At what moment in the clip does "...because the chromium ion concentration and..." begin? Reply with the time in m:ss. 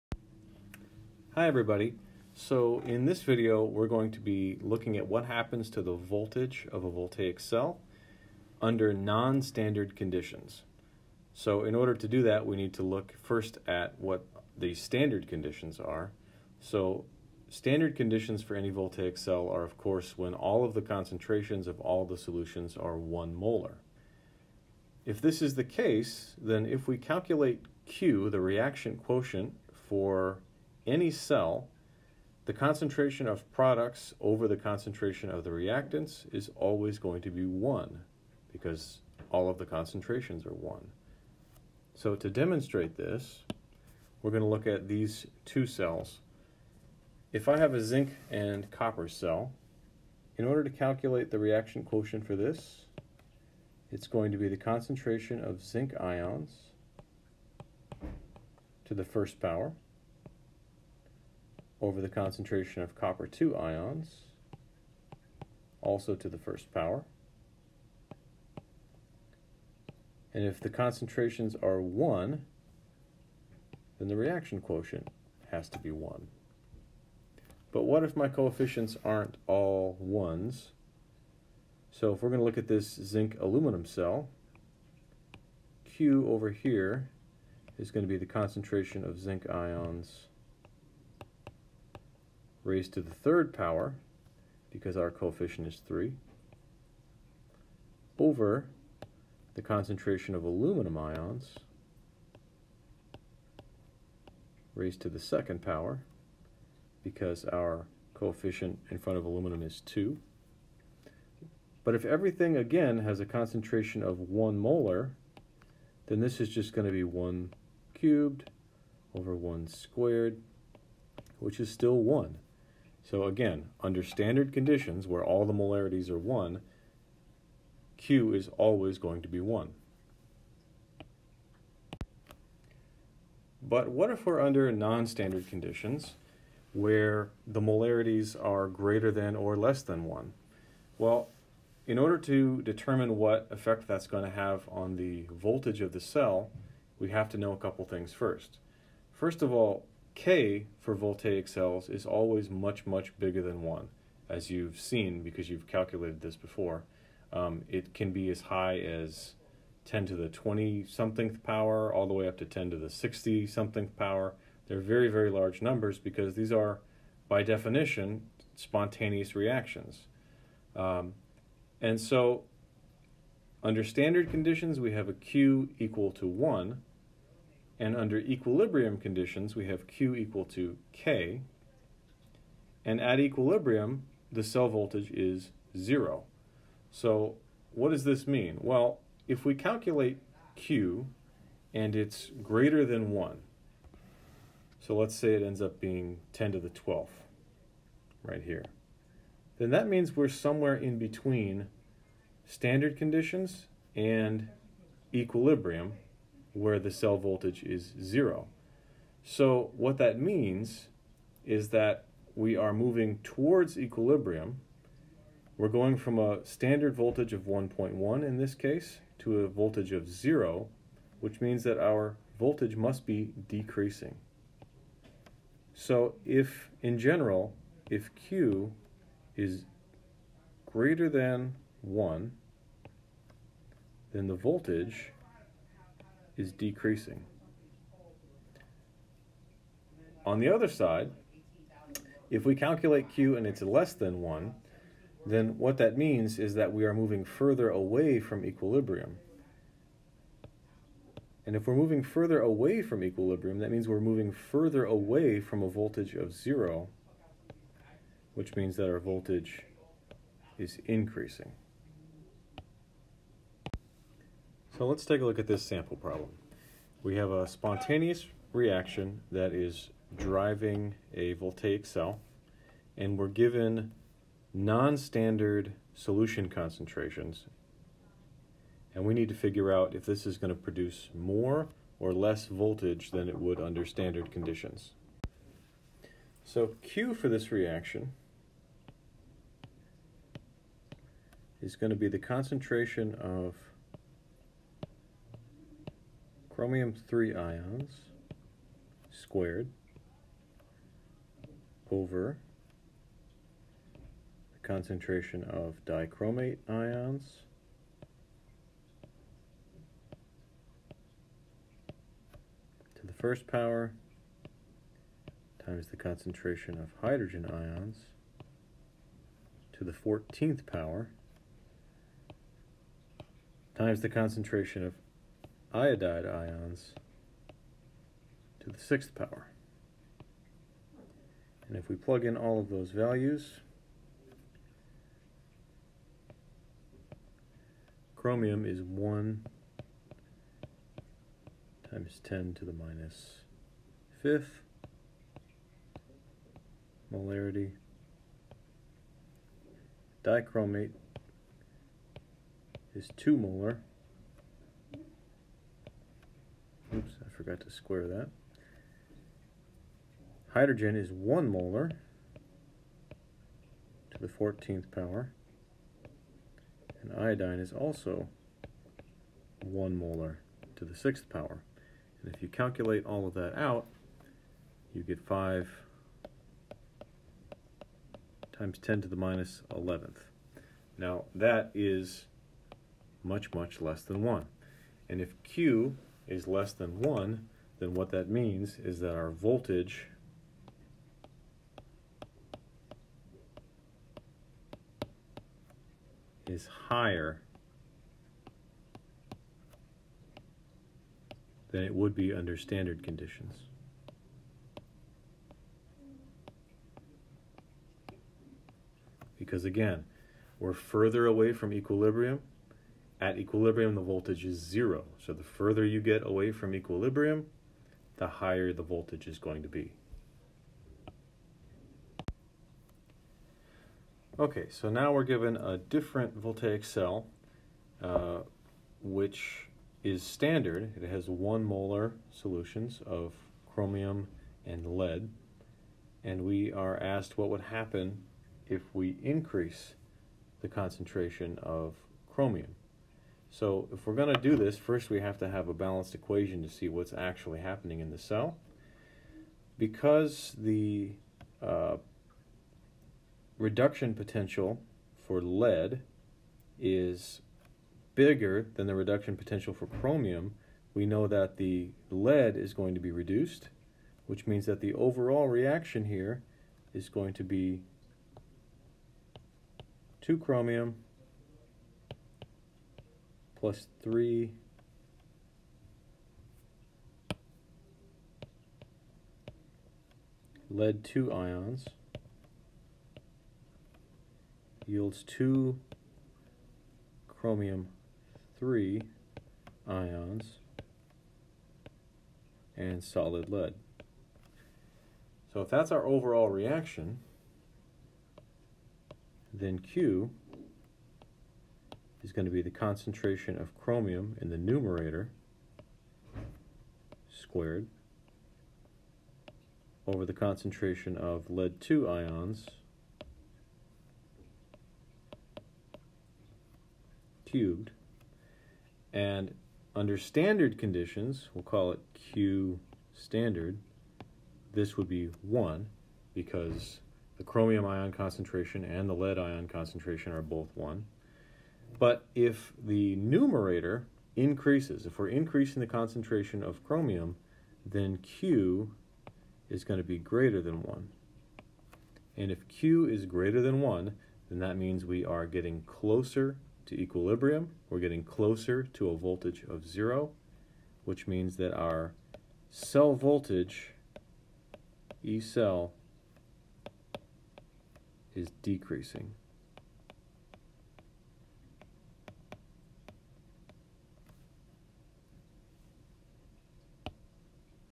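8:46.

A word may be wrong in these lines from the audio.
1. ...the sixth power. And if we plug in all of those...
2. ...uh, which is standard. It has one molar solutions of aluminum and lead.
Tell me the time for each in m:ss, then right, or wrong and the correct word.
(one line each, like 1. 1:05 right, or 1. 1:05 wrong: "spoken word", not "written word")
1. 5:28 right
2. 7:08 wrong: "chromium", not "aluminum".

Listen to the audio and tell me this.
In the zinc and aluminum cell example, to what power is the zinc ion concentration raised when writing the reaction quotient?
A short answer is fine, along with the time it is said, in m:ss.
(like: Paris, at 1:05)
third power, at 1:33.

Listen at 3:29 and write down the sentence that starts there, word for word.
So what that means is that we are moving towards equilibrium.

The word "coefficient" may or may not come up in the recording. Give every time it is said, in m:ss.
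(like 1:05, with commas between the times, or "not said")
1:18, 1:35, 1:48.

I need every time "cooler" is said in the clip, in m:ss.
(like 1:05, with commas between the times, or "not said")
not said.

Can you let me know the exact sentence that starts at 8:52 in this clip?
But if the numerator increases, if we're increasing the concentration of chromium, then Q is going to be greater than 1.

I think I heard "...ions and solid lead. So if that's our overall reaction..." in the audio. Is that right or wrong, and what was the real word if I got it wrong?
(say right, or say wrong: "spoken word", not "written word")
right.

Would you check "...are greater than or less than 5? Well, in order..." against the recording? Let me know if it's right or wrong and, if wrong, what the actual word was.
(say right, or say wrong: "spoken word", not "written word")
wrong: "1", not "5".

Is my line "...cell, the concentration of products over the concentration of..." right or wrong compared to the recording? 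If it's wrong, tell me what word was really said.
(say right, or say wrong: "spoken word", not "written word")
right.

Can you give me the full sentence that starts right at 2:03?
So again, under standard conditions where all the molarities are 1, Q is always going to be 1.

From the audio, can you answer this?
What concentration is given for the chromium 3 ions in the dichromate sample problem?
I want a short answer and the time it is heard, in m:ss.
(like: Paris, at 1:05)
1 × 10^-5 M, at 5:38.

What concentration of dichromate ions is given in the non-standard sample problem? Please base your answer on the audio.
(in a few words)
2 molar.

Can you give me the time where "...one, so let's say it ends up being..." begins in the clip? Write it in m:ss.
3:13.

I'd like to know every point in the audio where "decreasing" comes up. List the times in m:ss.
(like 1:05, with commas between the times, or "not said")
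3:43, 3:56, 9:18.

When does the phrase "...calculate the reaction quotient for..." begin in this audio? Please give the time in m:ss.
0:50.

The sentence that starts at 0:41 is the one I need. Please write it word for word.
So to demonstrate this, we're going to look at these two cells.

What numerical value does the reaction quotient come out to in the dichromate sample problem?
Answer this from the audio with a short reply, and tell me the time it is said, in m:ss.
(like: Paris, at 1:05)
5 × 10^-11, at 6:15.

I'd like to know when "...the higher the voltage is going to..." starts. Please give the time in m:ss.
6:58.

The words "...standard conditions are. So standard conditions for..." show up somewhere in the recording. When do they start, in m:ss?
0:14.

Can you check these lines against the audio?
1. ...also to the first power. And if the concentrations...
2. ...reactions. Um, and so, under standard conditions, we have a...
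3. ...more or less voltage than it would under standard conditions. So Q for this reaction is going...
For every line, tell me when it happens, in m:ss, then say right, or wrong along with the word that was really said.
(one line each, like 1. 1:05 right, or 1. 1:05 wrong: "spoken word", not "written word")
1. 1:05 right
2. 2:49 right
3. 4:41 right.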